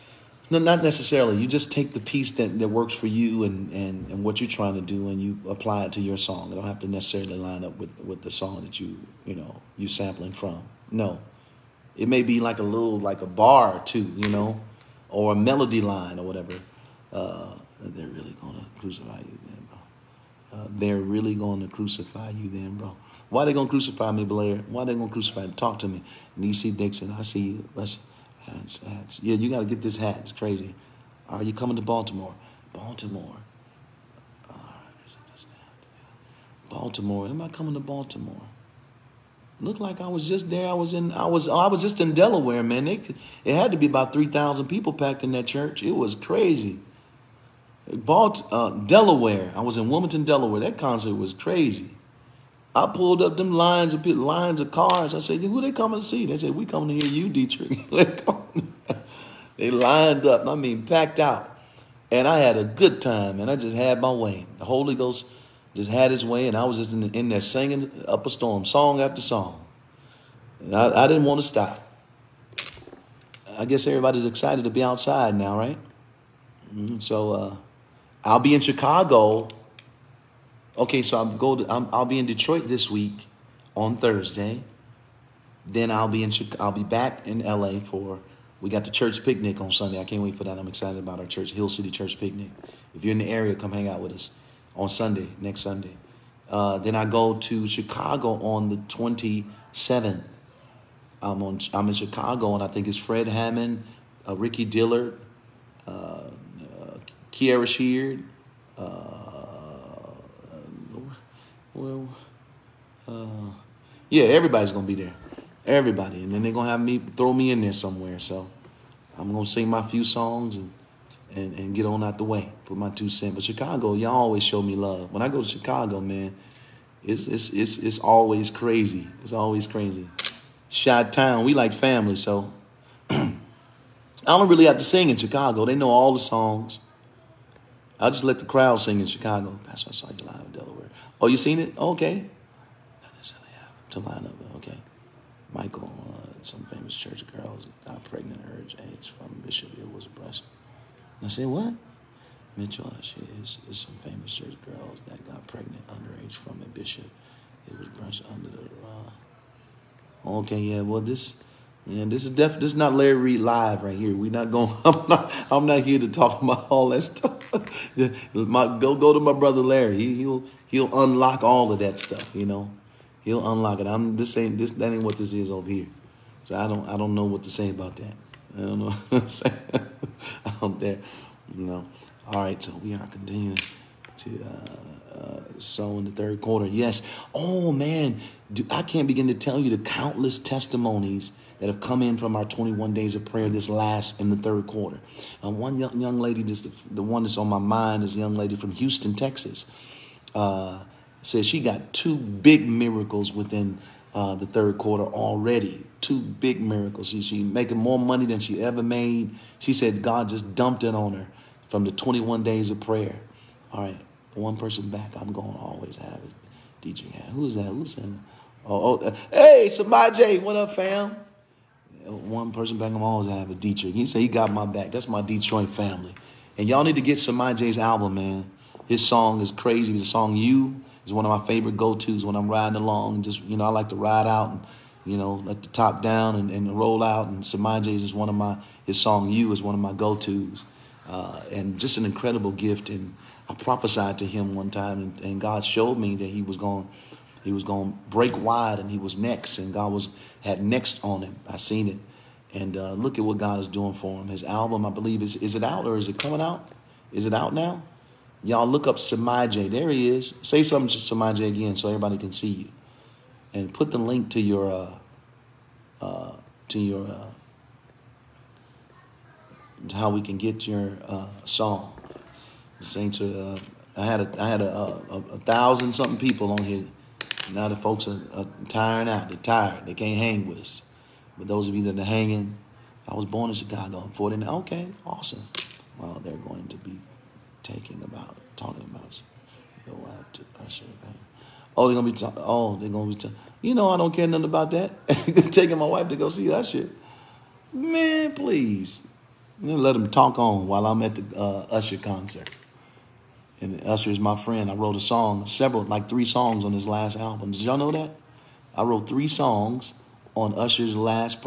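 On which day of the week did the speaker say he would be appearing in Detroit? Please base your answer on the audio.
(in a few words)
Thursday.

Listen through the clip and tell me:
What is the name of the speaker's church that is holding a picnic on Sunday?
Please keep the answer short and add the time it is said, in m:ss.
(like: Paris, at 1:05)
Hill City Church, at 1:31.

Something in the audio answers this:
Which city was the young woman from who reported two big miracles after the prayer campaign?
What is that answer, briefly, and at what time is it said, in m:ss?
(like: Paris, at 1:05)
Houston, at 3:18.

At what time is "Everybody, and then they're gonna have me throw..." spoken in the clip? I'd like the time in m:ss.
1:55.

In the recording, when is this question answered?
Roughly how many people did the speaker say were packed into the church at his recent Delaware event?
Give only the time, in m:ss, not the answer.
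0:44.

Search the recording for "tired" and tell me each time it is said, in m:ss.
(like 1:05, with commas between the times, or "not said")
4:39.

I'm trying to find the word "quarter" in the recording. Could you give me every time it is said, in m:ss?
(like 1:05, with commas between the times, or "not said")
3:06, 3:14, 3:24.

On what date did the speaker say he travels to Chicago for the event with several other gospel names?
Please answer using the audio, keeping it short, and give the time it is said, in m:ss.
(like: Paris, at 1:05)
the 27th, at 1:38.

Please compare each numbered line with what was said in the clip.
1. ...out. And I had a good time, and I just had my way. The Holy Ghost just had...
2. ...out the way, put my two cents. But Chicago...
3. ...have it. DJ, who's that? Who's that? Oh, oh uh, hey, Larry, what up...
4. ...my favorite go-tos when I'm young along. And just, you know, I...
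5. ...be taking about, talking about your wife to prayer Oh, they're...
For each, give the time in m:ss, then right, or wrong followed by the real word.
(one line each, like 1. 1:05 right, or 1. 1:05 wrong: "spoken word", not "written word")
1. 1:01 right
2. 2:02 right
3. 3:35 wrong: "Samaj", not "Larry"
4. 3:51 wrong: "riding", not "young"
5. 4:46 wrong: "usher", not "prayer".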